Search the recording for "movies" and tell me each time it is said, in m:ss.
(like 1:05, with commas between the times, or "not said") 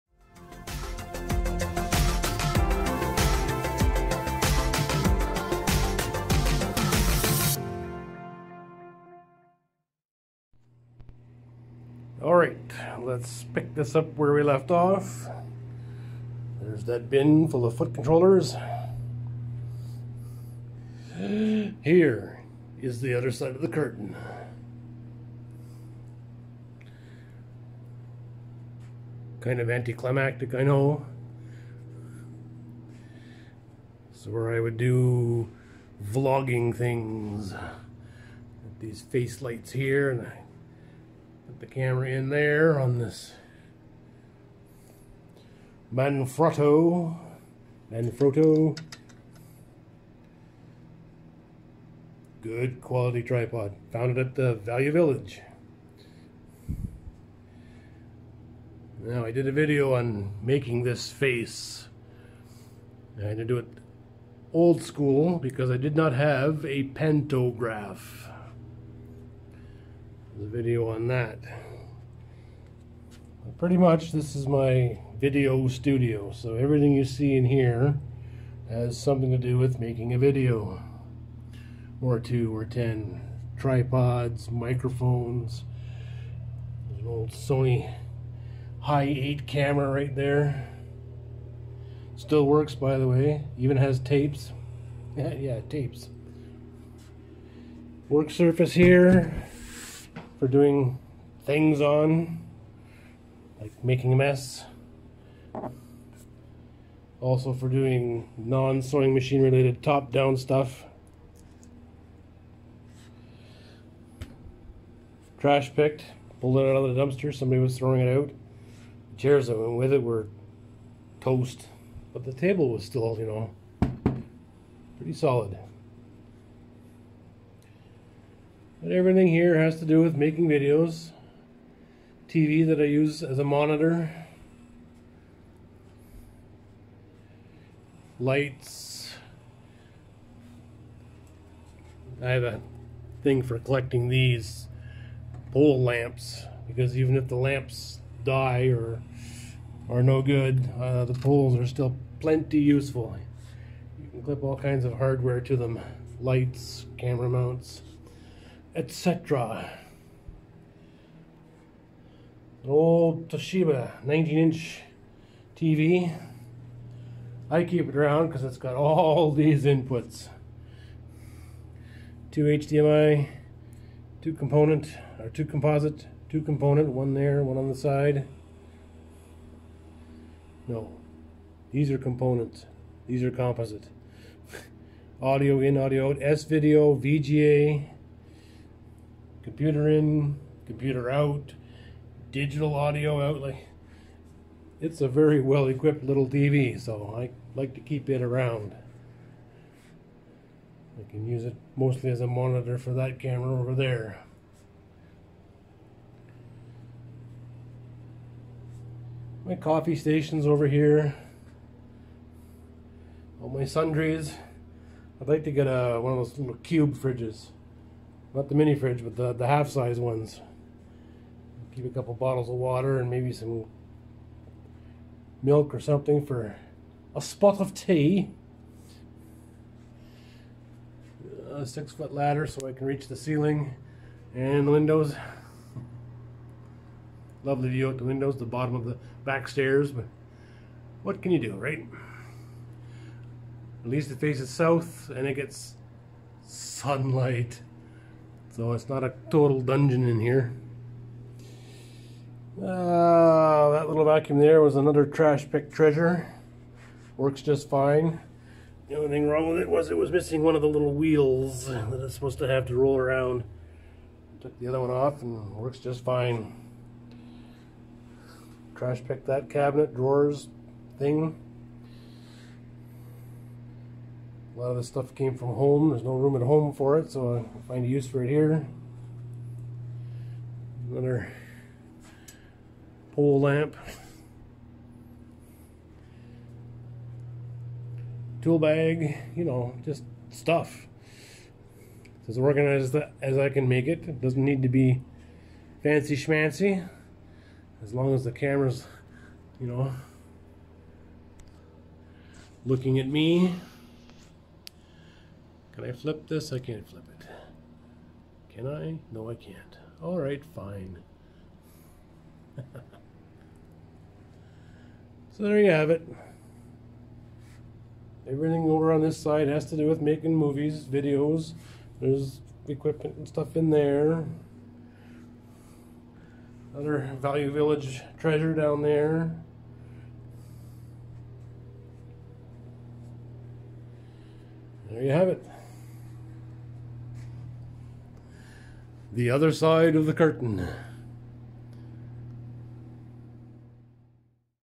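5:20.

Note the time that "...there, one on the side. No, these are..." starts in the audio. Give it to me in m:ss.
2:57.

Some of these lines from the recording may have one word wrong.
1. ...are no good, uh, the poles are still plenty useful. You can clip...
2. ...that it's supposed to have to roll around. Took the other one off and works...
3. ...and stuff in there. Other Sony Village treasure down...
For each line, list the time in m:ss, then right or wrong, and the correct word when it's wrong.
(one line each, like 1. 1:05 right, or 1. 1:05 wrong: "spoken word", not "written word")
1. 2:29 right
2. 4:21 right
3. 5:23 wrong: "Value", not "Sony".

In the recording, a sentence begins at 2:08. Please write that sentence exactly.
But everything here has to do with making videos.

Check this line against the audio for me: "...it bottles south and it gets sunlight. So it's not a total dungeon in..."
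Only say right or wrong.
wrong.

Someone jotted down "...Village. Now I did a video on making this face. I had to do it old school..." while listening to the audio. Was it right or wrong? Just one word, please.
right.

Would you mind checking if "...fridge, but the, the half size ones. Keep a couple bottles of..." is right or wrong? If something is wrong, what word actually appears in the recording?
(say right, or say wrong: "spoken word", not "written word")
right.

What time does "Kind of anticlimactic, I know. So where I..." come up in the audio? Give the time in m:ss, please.
0:29.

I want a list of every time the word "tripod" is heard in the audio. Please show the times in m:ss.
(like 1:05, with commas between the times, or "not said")
0:53, 1:23.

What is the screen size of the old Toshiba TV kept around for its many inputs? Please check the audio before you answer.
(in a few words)
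19 inch.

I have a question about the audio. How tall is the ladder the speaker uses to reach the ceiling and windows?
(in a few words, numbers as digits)
6 foot.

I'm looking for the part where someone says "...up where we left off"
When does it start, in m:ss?
0:13.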